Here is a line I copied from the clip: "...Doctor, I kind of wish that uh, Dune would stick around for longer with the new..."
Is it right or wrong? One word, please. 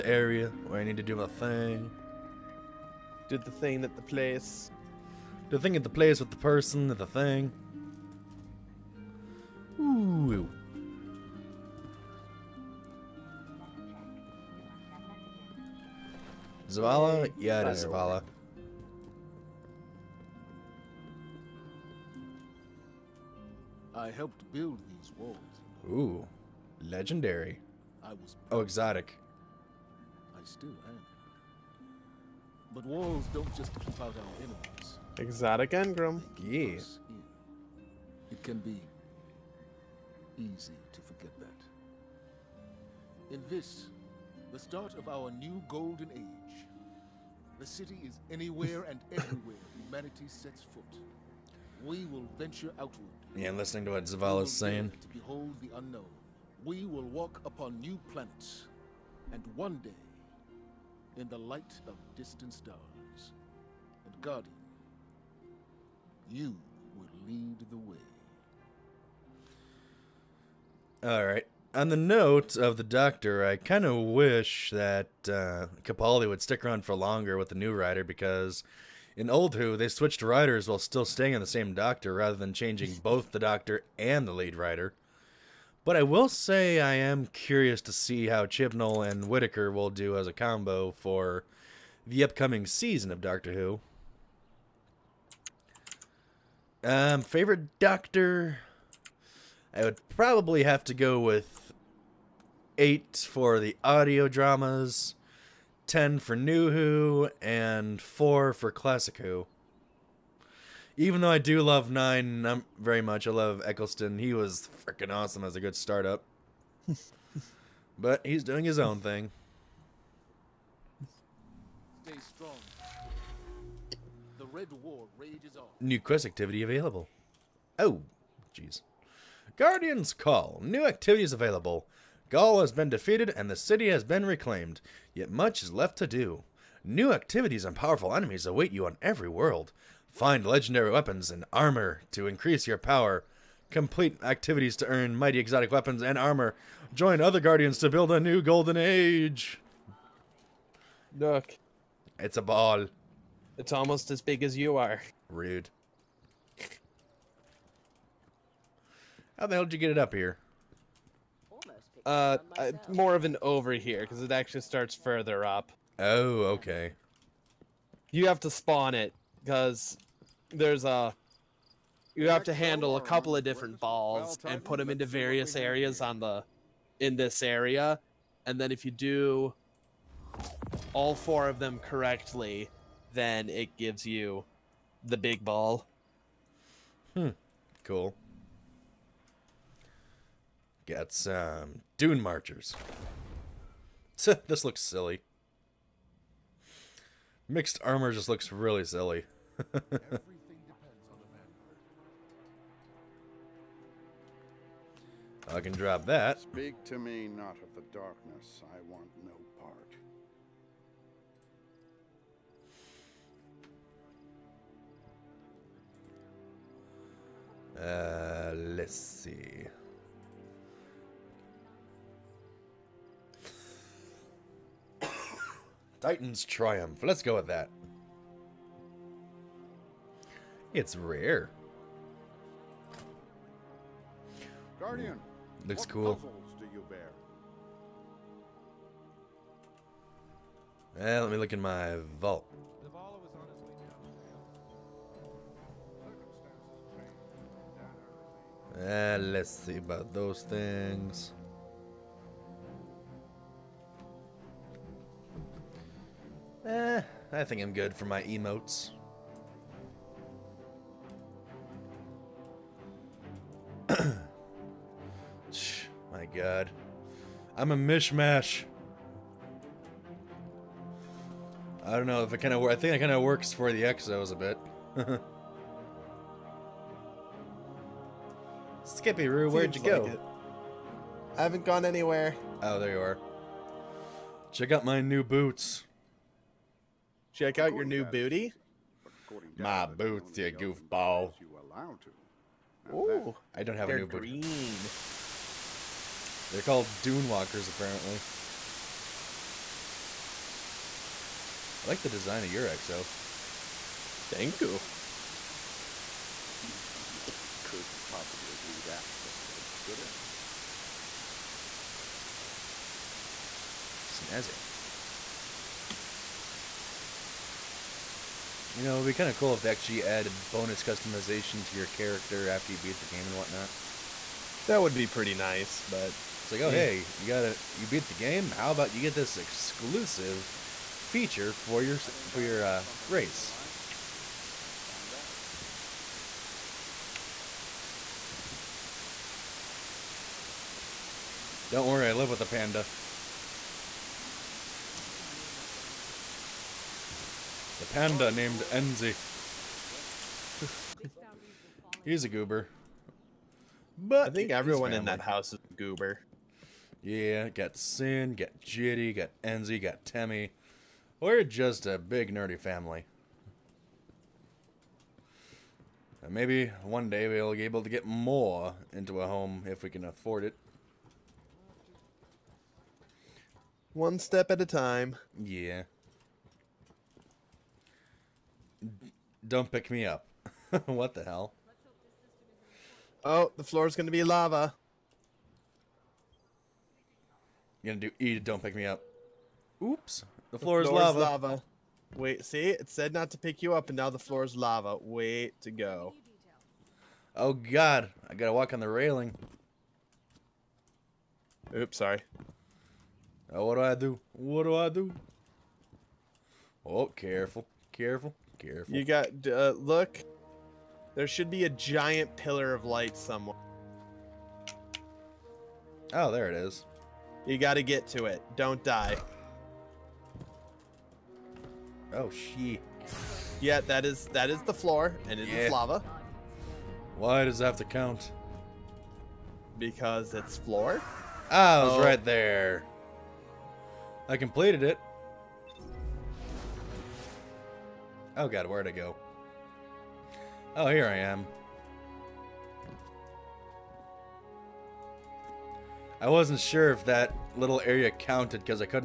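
wrong.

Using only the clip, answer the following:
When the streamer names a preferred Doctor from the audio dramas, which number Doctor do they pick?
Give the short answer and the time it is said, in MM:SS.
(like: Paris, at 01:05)
8, at 01:42.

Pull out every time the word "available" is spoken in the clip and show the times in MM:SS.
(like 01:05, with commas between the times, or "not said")
02:06, 02:11.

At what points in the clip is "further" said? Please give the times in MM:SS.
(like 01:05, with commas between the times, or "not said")
02:44.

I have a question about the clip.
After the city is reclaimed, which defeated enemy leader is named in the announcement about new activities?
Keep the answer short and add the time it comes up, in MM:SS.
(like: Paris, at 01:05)
Ghaul, at 02:12.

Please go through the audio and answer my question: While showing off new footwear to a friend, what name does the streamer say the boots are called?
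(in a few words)
Dune walkers.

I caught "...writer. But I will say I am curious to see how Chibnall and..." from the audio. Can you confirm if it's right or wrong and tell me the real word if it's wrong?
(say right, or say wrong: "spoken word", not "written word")
right.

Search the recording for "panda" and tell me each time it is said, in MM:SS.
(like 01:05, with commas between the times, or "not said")
05:42, 05:47.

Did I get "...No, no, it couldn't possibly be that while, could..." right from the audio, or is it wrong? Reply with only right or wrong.
wrong.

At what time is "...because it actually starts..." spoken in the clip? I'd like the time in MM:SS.
02:44.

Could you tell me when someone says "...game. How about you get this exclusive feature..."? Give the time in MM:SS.
05:28.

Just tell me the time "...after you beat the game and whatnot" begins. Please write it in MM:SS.
05:22.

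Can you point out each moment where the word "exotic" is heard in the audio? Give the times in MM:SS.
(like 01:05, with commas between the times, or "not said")
00:28, 00:35, 02:25.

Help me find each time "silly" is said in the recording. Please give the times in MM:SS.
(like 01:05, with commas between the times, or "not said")
03:14, 03:18.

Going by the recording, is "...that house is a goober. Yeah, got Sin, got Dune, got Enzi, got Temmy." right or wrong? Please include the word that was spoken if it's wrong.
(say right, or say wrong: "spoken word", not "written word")
wrong: "Jitty", not "Dune".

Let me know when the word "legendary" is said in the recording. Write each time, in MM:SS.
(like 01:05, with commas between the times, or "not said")
00:26, 02:20.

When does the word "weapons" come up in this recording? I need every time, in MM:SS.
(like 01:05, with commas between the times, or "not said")
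02:20, 02:25.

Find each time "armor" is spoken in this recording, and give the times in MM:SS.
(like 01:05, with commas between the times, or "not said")
02:21, 02:26, 03:17.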